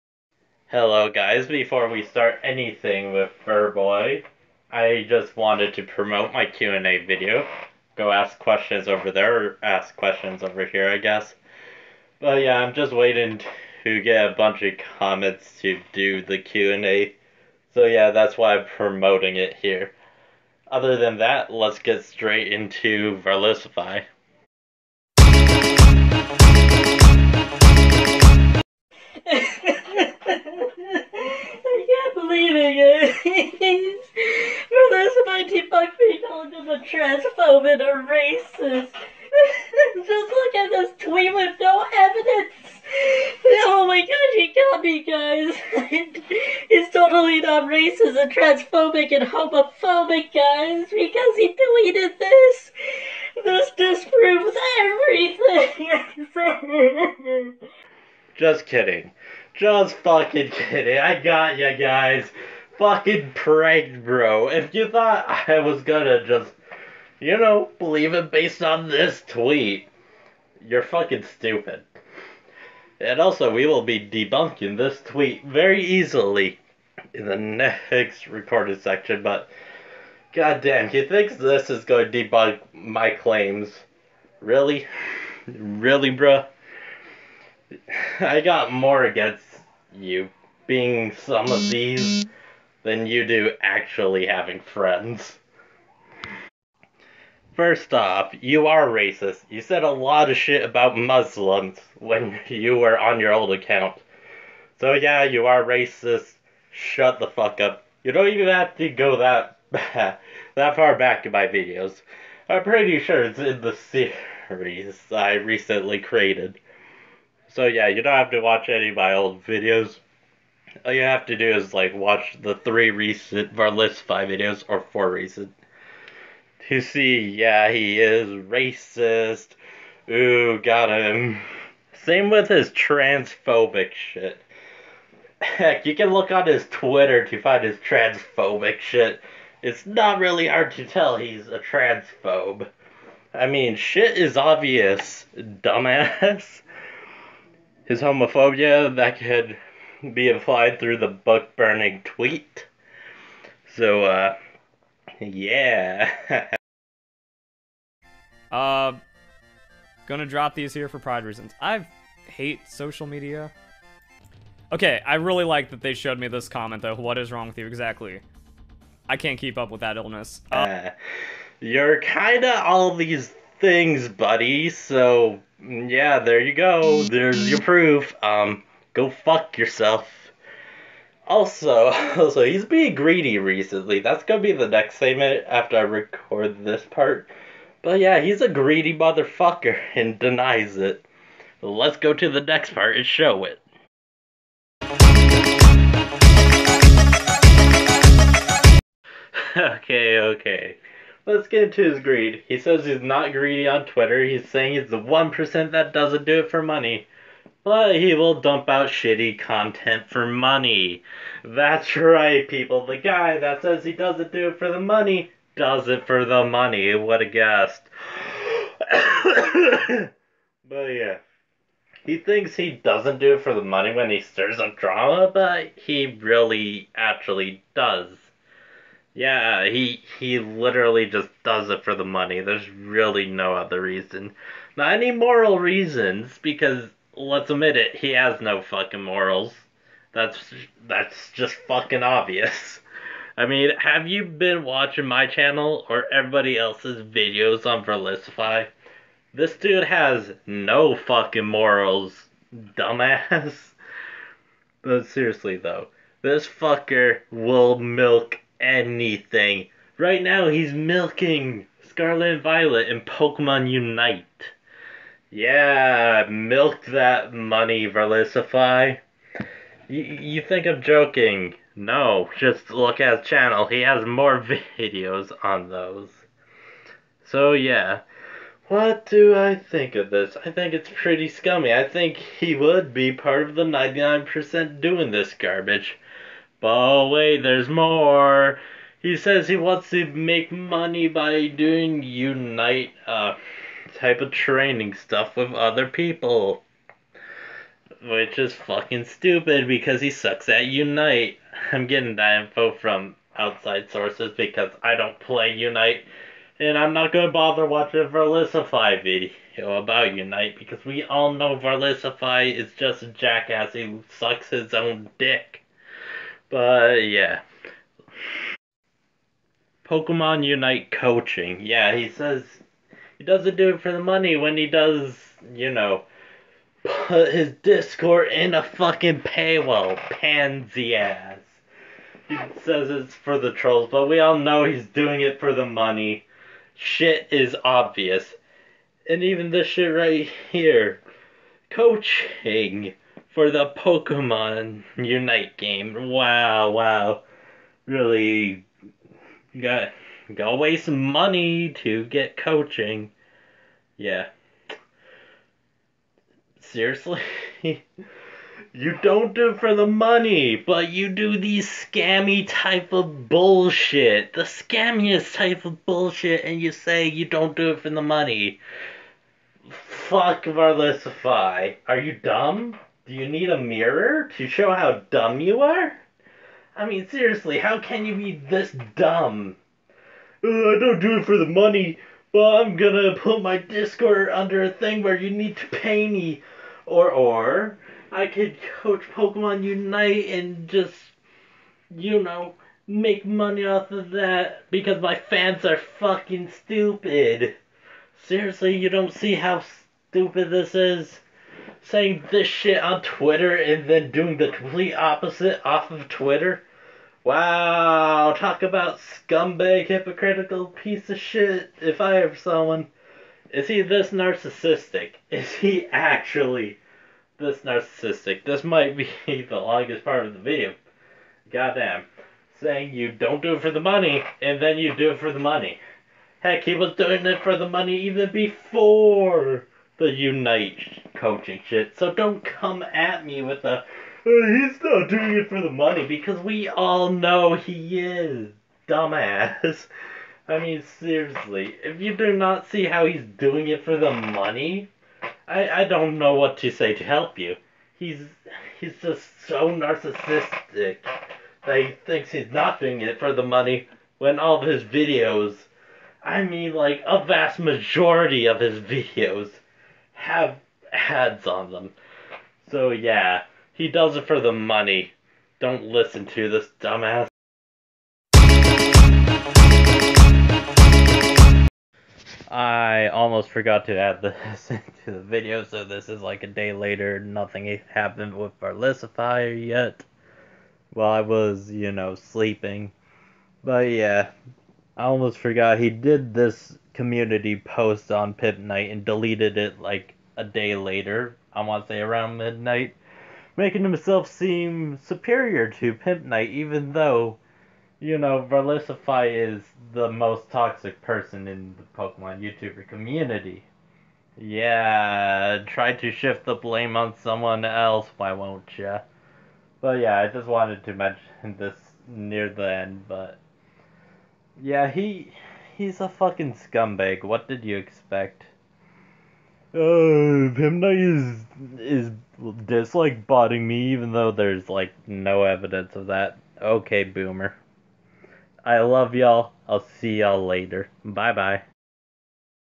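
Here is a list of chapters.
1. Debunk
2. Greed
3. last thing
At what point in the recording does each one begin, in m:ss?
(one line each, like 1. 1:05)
1. 0:25
2. 3:15
3. 7:48.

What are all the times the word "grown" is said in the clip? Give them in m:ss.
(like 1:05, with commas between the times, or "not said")
not said.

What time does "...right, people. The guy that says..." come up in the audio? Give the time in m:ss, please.
3:31.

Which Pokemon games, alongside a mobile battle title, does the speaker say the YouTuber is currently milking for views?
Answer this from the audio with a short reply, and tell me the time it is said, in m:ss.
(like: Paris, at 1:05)
Scarlet and Violet, at 4:21.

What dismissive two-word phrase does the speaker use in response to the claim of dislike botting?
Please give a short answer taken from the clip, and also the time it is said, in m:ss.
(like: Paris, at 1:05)
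Okay, boomer, at 8:46.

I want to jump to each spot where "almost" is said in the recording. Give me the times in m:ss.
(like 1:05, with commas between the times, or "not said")
7:53, 8:05.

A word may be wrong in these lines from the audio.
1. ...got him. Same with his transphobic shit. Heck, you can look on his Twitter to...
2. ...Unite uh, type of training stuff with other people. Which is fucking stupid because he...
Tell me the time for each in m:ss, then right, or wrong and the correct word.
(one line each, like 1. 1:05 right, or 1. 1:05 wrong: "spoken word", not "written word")
1. 2:10 right
2. 4:52 right.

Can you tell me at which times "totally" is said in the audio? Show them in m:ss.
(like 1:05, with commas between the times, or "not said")
0:46.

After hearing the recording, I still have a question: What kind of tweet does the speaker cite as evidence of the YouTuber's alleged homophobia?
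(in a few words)
book burning tweet.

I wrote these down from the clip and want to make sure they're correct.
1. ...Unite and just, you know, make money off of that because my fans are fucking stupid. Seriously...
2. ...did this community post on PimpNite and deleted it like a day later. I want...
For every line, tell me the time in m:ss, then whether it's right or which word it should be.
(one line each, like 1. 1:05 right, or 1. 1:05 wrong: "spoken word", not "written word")
1. 6:29 right
2. 8:05 right.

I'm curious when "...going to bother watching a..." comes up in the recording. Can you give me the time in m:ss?
5:07.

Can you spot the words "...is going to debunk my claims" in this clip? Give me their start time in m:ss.
1:21.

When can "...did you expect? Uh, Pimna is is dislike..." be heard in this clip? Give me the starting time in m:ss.
8:37.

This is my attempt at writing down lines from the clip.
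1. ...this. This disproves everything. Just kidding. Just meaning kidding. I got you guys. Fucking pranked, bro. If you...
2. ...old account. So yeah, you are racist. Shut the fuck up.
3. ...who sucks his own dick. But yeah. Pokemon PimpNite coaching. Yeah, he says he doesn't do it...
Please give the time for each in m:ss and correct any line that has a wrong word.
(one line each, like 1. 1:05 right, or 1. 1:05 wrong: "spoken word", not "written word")
1. 0:52 wrong: "fucking", not "meaning"
2. 1:43 right
3. 5:13 wrong: "Unite", not "PimpNite".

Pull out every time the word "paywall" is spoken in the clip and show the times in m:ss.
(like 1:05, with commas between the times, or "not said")
5:29.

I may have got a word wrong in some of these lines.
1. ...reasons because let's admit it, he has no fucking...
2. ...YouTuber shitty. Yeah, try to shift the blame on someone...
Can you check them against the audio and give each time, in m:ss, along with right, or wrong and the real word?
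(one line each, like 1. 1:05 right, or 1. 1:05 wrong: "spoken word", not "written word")
1. 3:55 right
2. 8:22 wrong: "community", not "shitty".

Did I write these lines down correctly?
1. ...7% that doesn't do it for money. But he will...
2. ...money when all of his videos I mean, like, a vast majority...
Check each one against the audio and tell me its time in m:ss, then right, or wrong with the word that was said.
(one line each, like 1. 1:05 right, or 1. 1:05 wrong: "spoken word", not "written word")
1. 3:24 wrong: "1", not "7"
2. 7:33 right.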